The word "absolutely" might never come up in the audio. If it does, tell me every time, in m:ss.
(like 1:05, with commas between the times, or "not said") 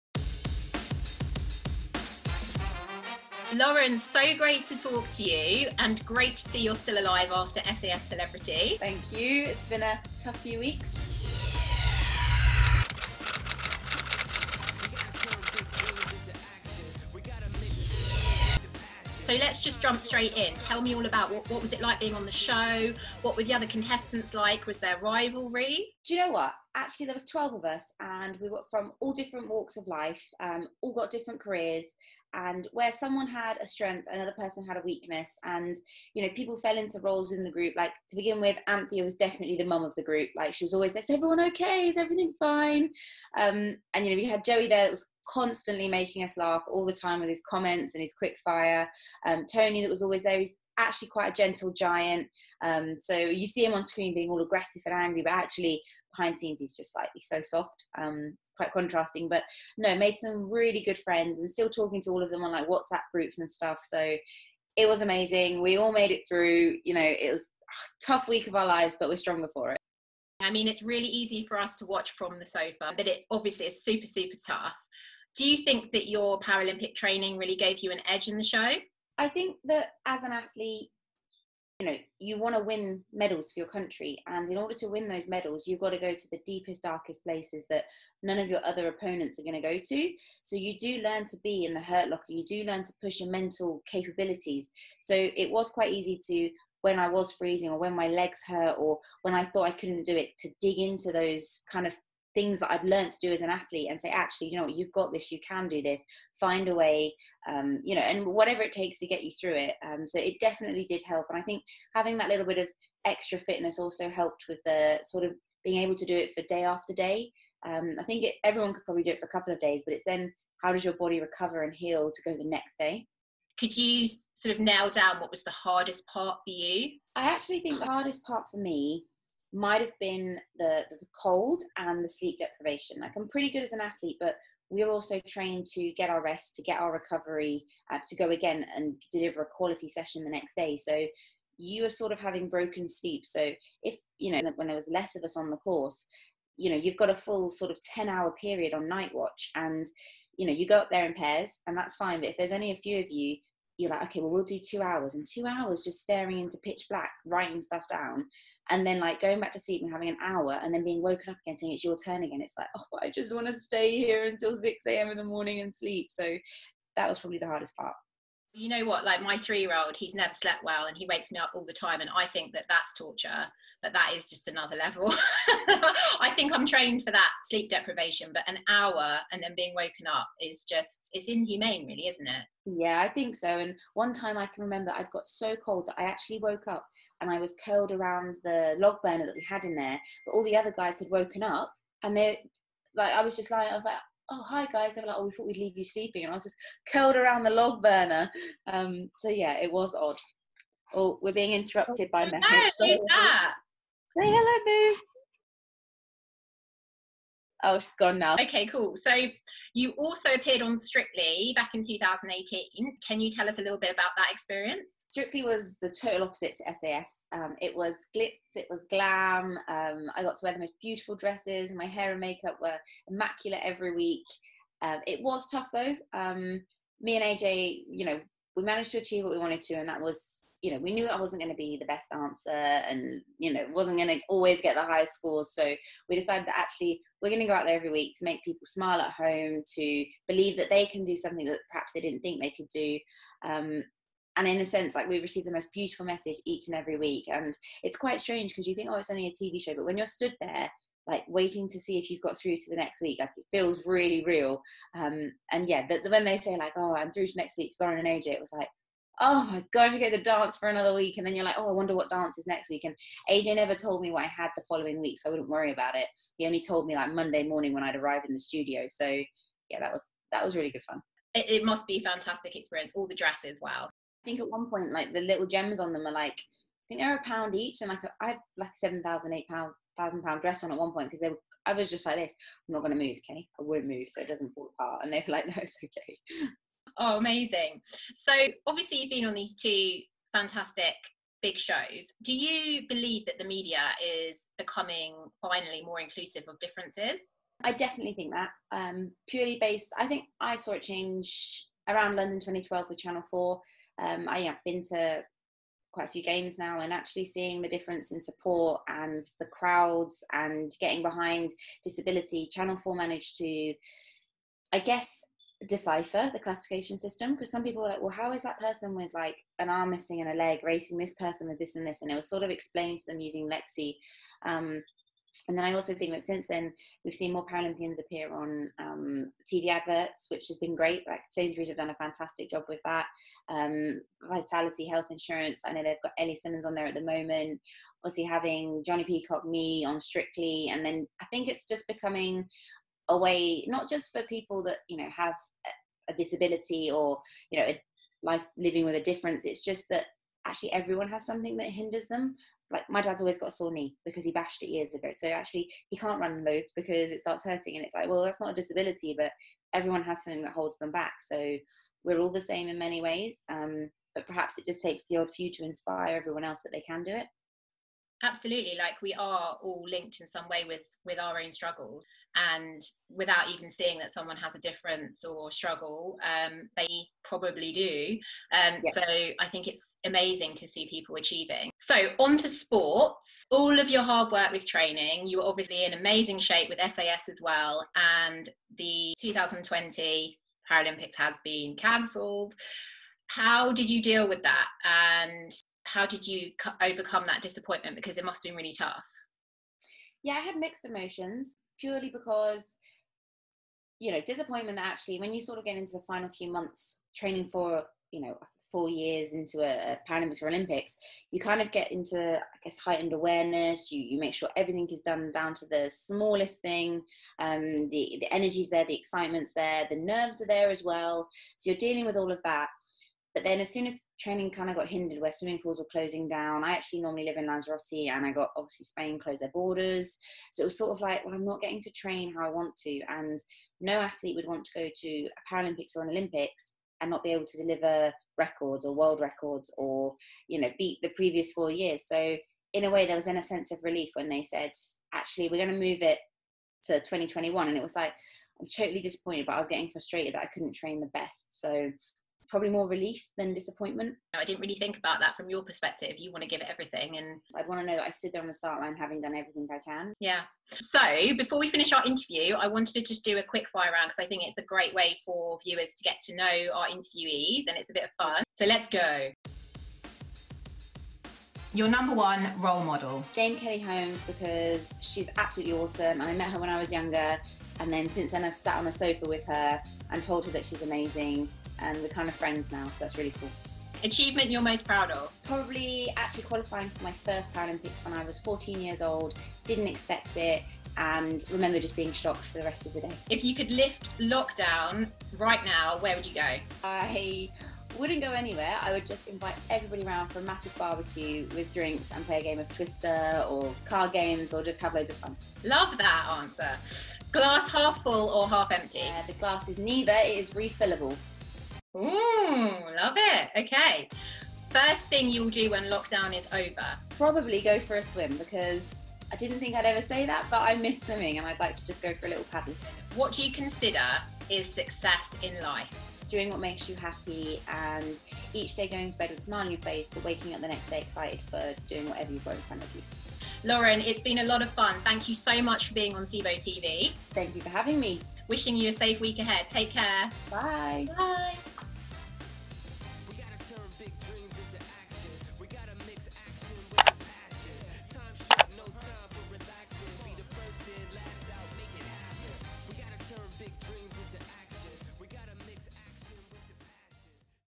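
6:08, 7:55.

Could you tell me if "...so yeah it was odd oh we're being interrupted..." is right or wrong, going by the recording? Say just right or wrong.
right.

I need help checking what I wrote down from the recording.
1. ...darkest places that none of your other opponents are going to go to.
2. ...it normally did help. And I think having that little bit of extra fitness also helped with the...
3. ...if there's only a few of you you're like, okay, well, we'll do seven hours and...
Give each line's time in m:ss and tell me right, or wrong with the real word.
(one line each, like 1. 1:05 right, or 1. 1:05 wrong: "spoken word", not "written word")
1. 1:26 right
2. 1:50 wrong: "definitely", not "normally"
3. 2:32 wrong: "two", not "seven".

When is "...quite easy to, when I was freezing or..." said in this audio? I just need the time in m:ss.
1:35.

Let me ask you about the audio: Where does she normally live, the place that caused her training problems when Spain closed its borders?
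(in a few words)
Lanzarote.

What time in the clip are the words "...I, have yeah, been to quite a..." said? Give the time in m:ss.
5:04.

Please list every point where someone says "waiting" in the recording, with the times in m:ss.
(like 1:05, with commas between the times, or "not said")
4:11.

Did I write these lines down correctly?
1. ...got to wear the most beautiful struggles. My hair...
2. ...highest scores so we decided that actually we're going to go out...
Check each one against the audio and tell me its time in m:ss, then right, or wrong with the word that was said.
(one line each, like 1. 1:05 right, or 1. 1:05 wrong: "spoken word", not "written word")
1. 3:40 wrong: "dresses", not "struggles"
2. 3:54 right.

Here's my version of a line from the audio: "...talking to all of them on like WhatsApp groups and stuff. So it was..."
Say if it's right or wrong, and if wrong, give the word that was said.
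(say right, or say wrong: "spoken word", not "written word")
right.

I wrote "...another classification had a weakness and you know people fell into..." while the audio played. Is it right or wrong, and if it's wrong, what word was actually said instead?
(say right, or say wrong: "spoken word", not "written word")
wrong: "person", not "classification".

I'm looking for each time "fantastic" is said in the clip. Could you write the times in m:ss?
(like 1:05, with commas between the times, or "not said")
4:32, 4:50, 5:31.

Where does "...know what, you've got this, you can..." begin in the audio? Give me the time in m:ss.
1:44.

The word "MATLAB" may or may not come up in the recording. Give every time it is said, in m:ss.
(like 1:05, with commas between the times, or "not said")
not said.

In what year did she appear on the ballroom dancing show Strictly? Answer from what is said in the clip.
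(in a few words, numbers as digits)
2018.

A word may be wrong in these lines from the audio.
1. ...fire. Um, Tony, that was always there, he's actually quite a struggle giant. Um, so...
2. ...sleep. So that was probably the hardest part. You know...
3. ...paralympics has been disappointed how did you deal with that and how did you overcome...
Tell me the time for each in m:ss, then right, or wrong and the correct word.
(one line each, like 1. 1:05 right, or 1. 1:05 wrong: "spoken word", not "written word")
1. 0:48 wrong: "gentle", not "struggle"
2. 2:45 right
3. 6:30 wrong: "cancelled", not "disappointed".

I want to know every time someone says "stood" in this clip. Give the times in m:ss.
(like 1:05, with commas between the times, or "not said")
4:10, 7:38.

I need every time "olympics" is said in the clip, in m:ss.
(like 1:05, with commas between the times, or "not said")
6:50, 7:16.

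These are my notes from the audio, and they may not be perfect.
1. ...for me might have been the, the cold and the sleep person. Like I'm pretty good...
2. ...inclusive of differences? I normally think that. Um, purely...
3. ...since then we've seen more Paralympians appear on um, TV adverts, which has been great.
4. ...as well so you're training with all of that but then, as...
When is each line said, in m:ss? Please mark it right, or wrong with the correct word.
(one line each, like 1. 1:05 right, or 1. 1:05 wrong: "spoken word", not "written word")
1. 2:08 wrong: "deprivation", not "person"
2. 4:56 wrong: "definitely", not "normally"
3. 5:26 right
4. 7:00 wrong: "dealing", not "training".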